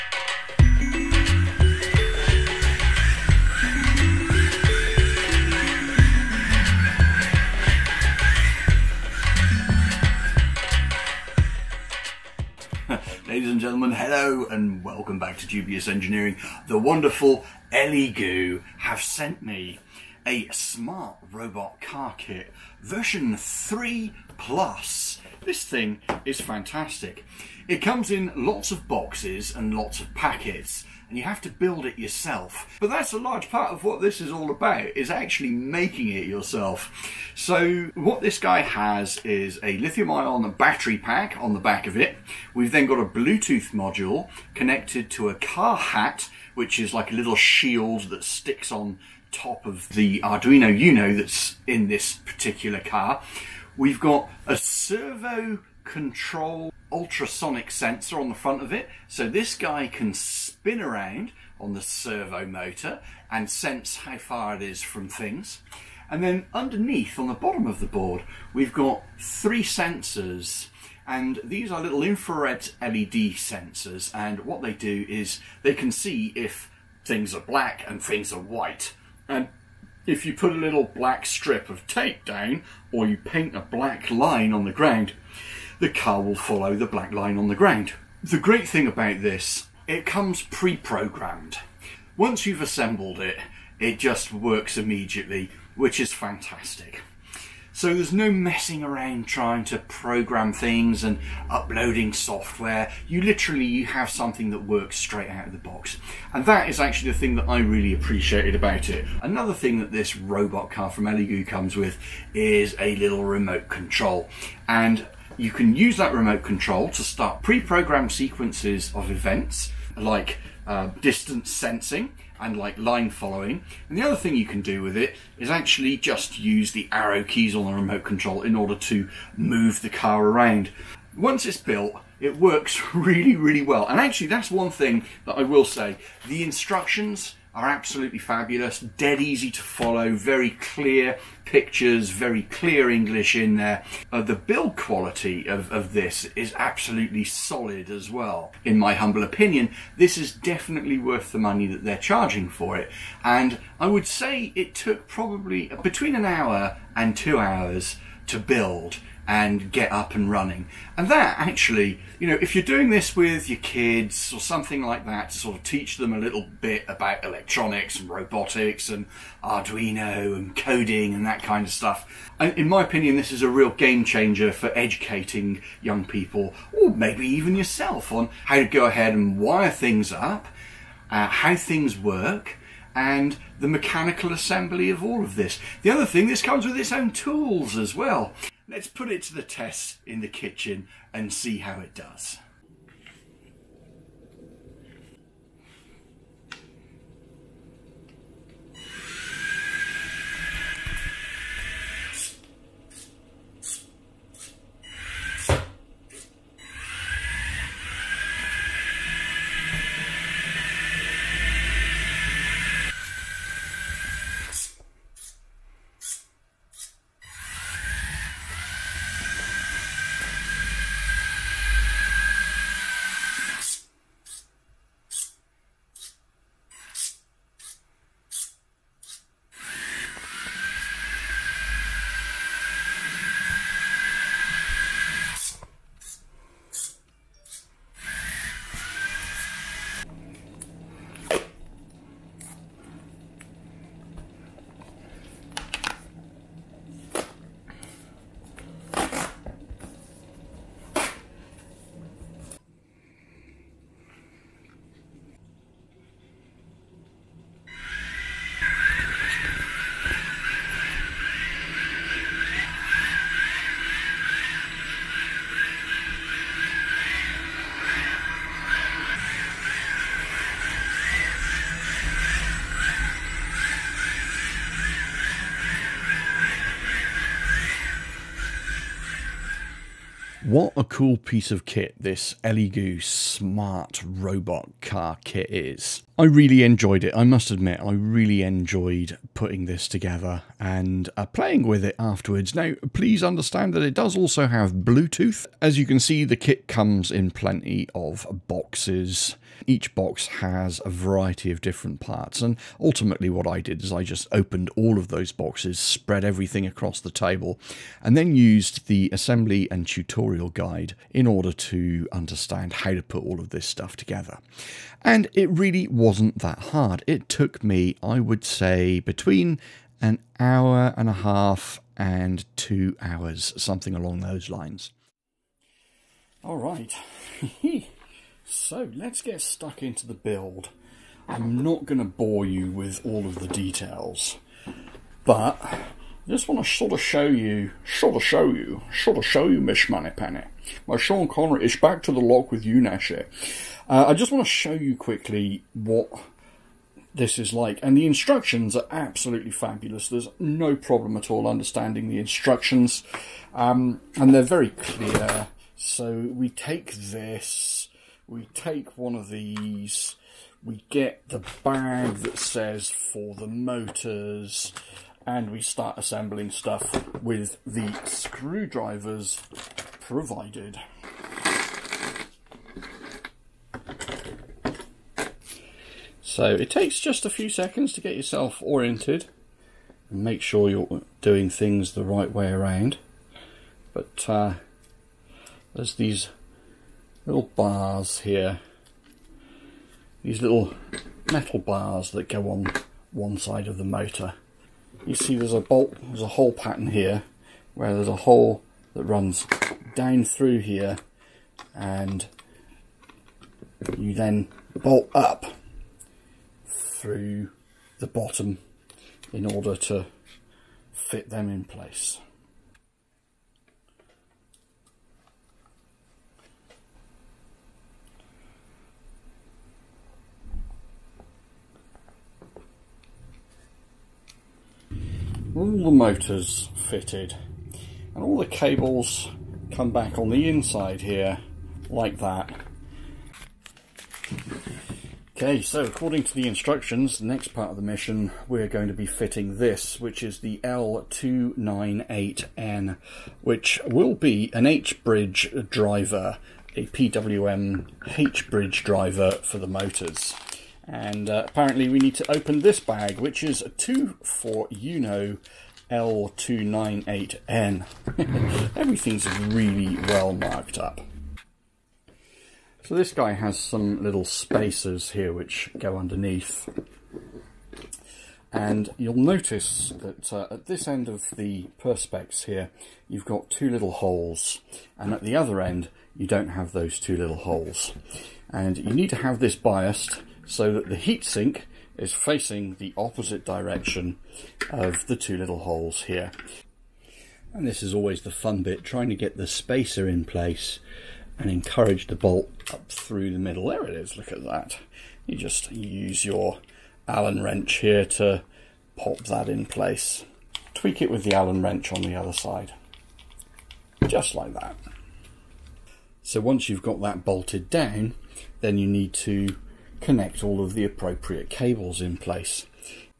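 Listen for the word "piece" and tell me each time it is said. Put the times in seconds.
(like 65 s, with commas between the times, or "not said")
281 s.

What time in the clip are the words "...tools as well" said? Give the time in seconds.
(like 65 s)
187 s.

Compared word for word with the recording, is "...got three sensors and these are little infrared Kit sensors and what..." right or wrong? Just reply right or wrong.
wrong.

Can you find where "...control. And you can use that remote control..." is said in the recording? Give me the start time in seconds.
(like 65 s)
113 s.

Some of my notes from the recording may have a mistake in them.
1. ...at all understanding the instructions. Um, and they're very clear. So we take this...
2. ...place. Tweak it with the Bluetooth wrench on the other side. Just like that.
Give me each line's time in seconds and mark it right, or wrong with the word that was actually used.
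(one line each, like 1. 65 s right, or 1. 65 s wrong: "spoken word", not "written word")
1. 351 s right
2. 499 s wrong: "Allen", not "Bluetooth".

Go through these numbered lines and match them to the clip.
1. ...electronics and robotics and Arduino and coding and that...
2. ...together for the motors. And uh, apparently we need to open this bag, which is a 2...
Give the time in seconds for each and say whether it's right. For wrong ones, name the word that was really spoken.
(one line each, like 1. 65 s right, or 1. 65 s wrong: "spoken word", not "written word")
1. 167 s right
2. 448 s wrong: "driver", not "together".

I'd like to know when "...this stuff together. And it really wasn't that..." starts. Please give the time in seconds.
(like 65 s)
313 s.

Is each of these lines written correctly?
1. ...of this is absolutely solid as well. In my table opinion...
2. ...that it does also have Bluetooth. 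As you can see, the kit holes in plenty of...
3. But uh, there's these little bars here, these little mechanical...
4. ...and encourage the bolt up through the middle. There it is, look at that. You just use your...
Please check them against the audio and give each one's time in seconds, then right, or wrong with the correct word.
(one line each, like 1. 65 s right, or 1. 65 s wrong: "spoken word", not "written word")
1. 145 s wrong: "humble", not "table"
2. 293 s wrong: "comes", not "holes"
3. 383 s wrong: "metal", not "mechanical"
4. 491 s right.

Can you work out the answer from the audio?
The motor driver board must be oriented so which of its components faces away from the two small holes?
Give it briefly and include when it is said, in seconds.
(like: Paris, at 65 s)
Heatsink, at 480 s.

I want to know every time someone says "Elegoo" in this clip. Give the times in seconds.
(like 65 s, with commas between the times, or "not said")
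17 s, 111 s, 282 s.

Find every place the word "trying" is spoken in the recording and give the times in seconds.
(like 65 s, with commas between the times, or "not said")
99 s, 488 s.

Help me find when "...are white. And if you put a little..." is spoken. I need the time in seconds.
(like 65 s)
78 s.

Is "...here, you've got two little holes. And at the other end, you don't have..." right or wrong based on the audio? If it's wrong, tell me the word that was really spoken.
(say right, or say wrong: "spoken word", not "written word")
right.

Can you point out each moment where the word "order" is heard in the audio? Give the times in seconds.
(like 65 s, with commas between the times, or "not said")
128 s, 311 s, 409 s.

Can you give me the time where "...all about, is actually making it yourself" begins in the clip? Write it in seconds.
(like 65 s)
34 s.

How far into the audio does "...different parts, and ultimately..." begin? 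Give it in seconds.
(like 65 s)
301 s.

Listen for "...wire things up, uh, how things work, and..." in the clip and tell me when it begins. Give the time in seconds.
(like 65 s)
179 s.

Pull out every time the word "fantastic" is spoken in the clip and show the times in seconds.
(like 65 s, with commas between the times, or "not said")
26 s, 96 s.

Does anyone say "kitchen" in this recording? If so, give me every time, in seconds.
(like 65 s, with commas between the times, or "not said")
190 s.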